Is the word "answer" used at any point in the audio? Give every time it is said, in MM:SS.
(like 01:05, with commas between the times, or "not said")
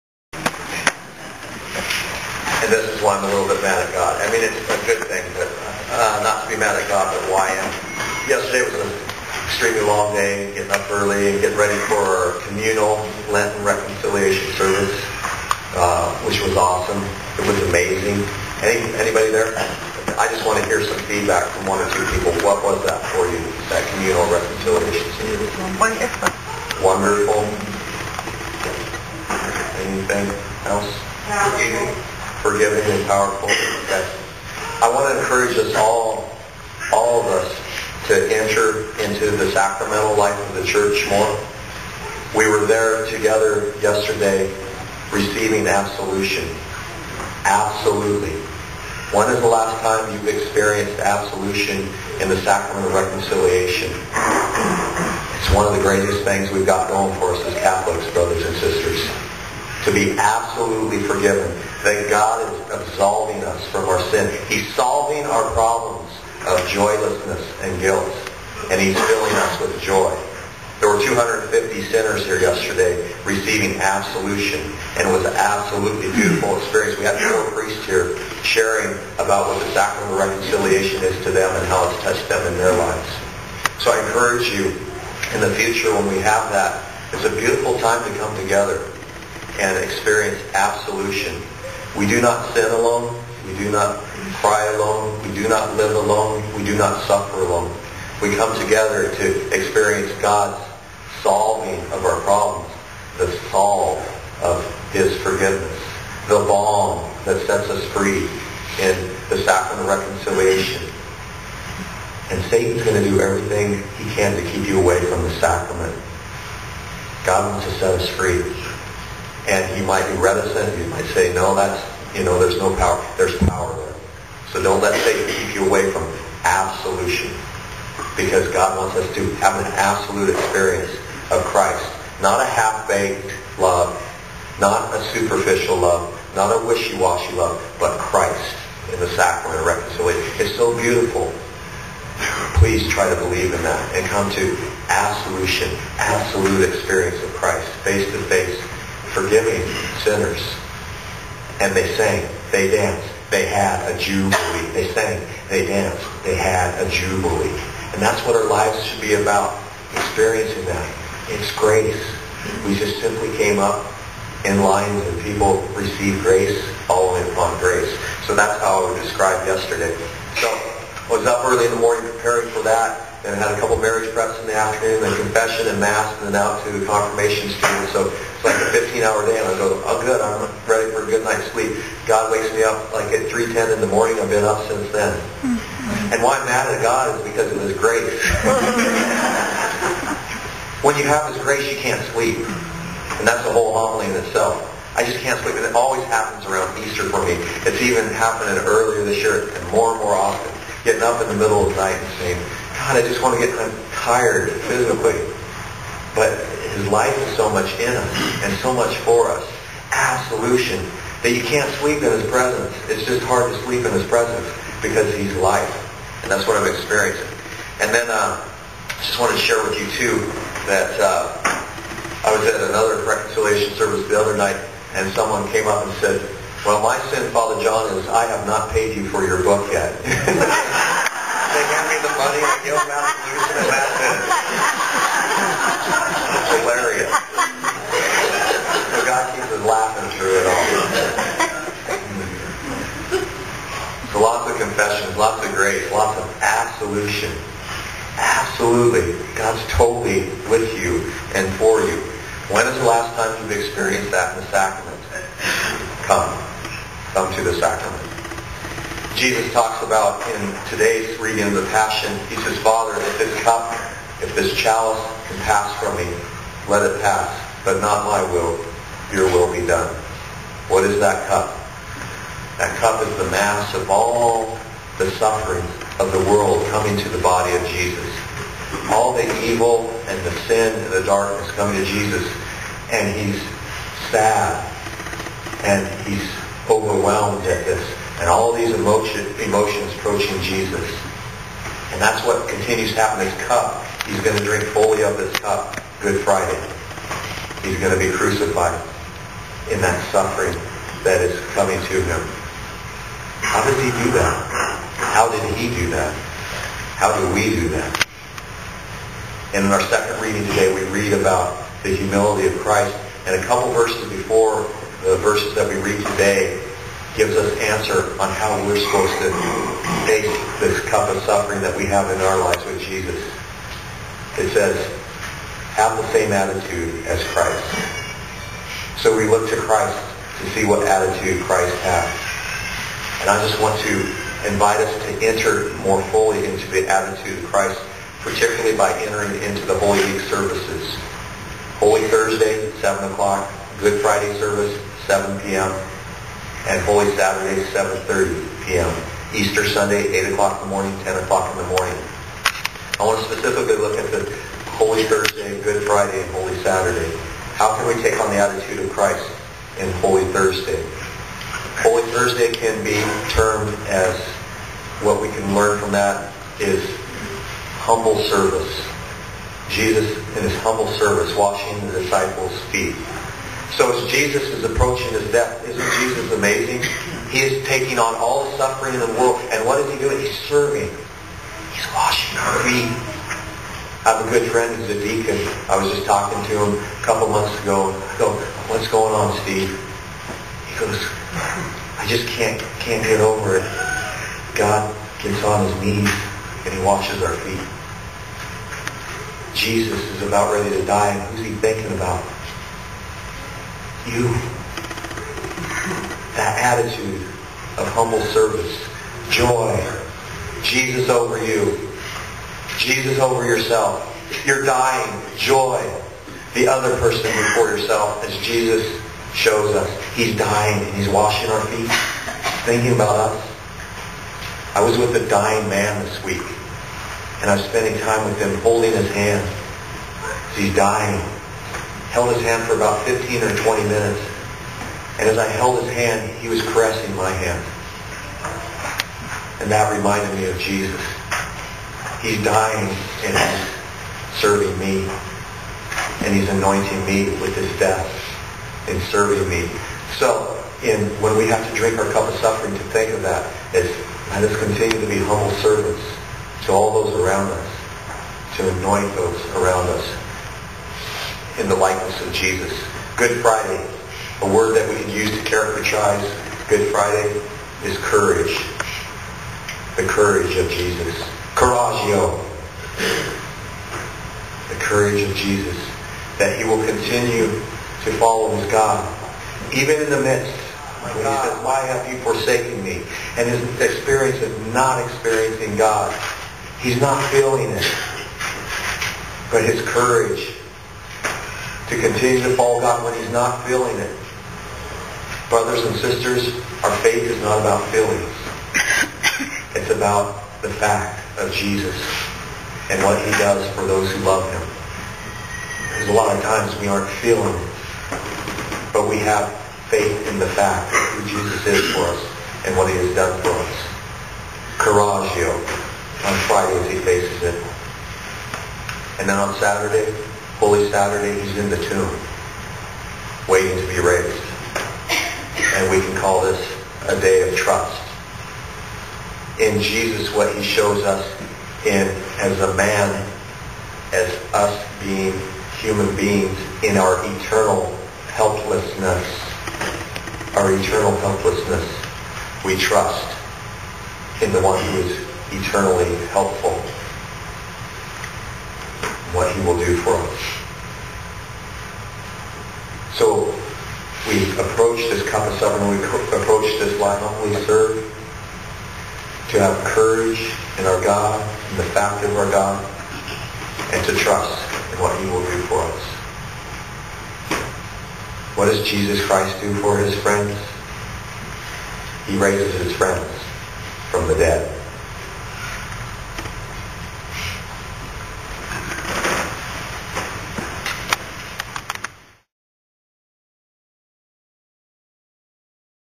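05:17.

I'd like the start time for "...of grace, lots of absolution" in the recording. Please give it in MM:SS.
04:05.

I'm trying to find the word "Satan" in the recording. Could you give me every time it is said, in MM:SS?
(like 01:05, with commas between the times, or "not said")
01:52, 02:05.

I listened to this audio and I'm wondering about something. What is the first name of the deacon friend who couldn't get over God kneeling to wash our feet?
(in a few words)
Steve.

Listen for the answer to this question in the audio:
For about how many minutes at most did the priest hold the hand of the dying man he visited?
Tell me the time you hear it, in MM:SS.
07:13.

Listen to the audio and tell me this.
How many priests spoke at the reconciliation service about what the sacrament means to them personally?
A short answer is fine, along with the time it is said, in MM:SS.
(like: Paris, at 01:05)
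4, at 01:17.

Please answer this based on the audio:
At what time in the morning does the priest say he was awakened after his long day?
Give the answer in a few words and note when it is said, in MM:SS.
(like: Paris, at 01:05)
3:10, at 03:03.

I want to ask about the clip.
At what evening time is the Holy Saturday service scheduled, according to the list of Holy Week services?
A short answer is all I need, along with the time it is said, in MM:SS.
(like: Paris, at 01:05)
7:30 p.m., at 05:47.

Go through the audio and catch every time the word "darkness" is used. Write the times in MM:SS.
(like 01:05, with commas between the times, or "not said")
04:41.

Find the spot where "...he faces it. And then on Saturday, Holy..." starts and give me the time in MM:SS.
08:36.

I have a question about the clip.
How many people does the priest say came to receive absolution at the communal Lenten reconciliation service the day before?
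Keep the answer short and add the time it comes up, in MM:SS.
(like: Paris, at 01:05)
250, at 01:11.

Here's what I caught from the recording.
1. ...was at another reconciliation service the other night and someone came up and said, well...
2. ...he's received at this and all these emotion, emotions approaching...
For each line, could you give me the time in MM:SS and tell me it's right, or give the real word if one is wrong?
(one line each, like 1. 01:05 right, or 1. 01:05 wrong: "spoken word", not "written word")
1. 03:42 right
2. 04:46 wrong: "overwhelmed", not "received".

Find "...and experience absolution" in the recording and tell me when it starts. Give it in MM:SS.
01:29.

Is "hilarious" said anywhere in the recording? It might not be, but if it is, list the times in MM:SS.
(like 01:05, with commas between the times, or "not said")
03:56.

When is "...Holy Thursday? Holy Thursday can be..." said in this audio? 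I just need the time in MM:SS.
05:59.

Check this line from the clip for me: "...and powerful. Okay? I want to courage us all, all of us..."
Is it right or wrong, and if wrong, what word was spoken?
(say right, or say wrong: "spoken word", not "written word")
wrong: "encourage", not "courage".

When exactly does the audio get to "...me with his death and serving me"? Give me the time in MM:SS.
07:27.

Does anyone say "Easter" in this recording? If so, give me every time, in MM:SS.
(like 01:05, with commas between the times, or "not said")
03:16, 05:49.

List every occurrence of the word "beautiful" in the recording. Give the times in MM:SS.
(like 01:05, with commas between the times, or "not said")
01:16, 01:27, 02:20.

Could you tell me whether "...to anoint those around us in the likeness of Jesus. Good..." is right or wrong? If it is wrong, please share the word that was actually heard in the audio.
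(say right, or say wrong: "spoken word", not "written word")
right.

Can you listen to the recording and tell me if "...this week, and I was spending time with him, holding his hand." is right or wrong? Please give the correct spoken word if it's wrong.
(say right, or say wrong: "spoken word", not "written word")
right.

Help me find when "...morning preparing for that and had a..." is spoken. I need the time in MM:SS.
02:51.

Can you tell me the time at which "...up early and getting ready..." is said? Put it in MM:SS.
00:10.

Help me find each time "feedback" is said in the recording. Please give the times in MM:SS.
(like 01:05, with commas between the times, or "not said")
00:21.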